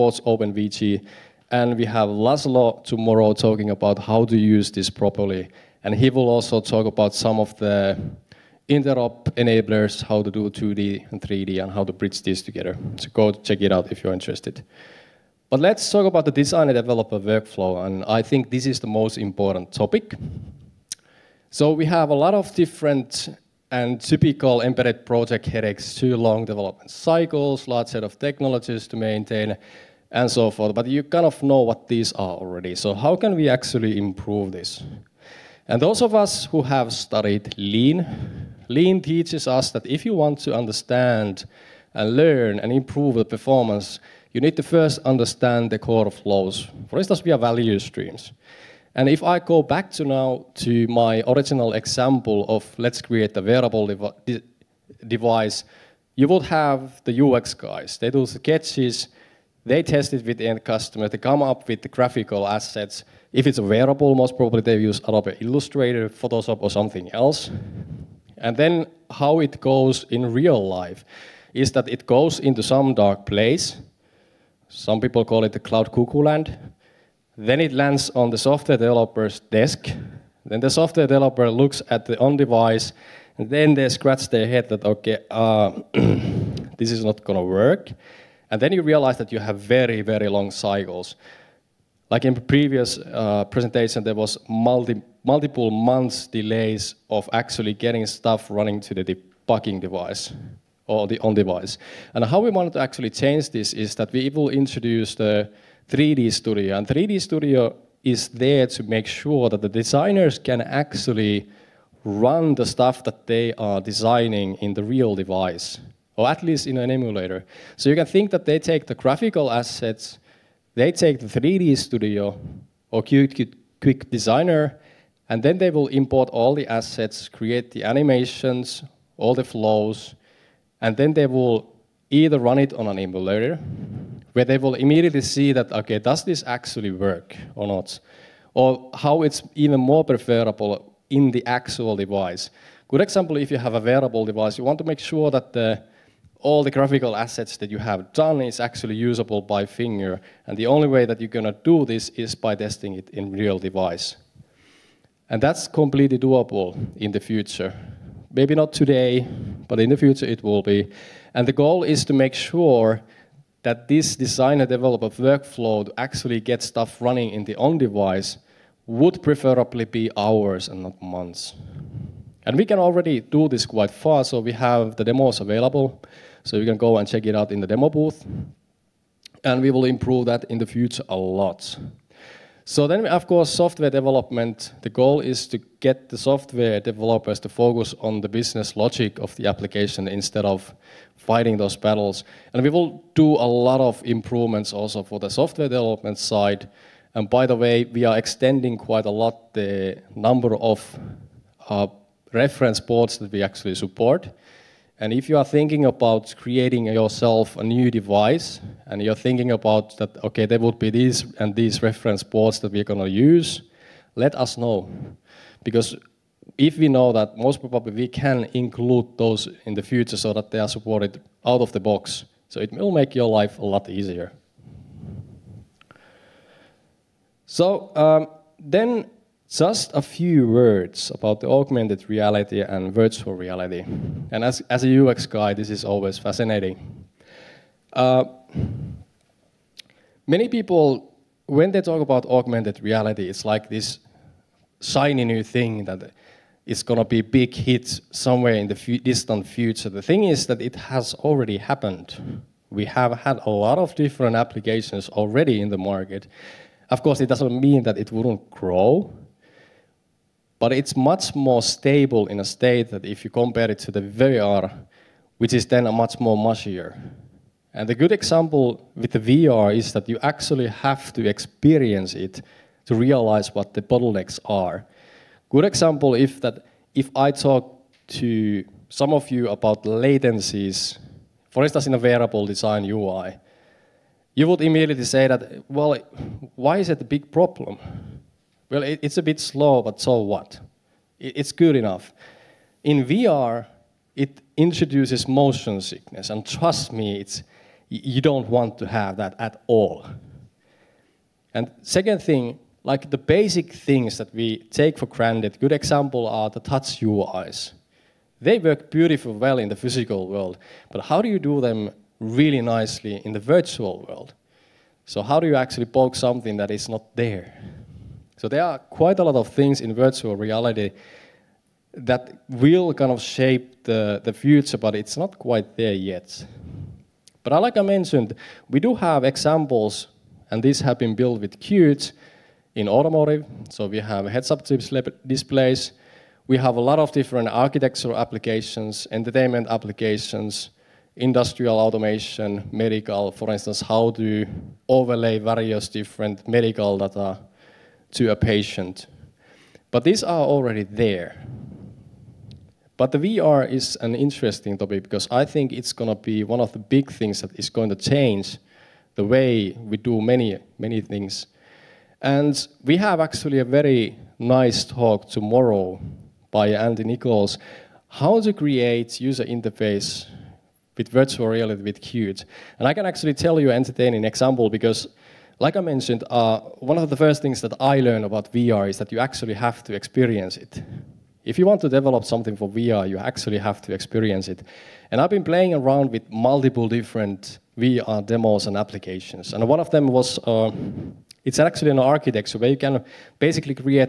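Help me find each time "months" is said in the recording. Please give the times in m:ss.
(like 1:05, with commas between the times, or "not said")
1:35, 2:51.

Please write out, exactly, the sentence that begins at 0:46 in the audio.
For instance, we have value streams.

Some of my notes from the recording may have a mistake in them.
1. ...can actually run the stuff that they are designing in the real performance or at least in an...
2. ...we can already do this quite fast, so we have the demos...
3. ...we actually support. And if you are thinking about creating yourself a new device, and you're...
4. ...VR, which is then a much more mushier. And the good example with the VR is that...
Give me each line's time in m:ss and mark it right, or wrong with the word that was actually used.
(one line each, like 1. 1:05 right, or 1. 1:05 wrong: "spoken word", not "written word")
1. 1:50 wrong: "device", not "performance"
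2. 2:52 right
3. 3:23 right
4. 4:24 right.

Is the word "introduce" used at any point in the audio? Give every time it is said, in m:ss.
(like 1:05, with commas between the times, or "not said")
1:44, 4:54.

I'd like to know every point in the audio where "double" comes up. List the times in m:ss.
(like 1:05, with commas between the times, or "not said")
not said.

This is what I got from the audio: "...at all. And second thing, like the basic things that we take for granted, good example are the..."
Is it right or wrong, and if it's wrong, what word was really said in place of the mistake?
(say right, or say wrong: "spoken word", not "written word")
right.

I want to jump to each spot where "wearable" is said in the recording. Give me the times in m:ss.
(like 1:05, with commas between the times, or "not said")
0:53, 1:03, 2:23.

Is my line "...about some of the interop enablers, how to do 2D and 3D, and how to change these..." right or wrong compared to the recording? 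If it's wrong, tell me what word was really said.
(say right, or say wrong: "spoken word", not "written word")
wrong: "bridge", not "change".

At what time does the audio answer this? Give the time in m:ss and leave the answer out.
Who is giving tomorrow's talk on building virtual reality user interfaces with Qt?
6:06.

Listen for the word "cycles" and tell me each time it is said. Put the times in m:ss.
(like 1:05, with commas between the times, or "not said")
0:26, 1:30.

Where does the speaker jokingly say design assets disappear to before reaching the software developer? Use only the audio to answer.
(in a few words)
cloud cuckoo land.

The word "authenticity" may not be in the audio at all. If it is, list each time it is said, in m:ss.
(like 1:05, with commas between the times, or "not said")
not said.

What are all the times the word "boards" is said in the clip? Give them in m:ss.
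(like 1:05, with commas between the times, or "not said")
3:22, 3:32.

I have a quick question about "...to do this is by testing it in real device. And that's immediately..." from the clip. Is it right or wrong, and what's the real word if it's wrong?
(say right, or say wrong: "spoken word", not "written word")
wrong: "completely", not "immediately".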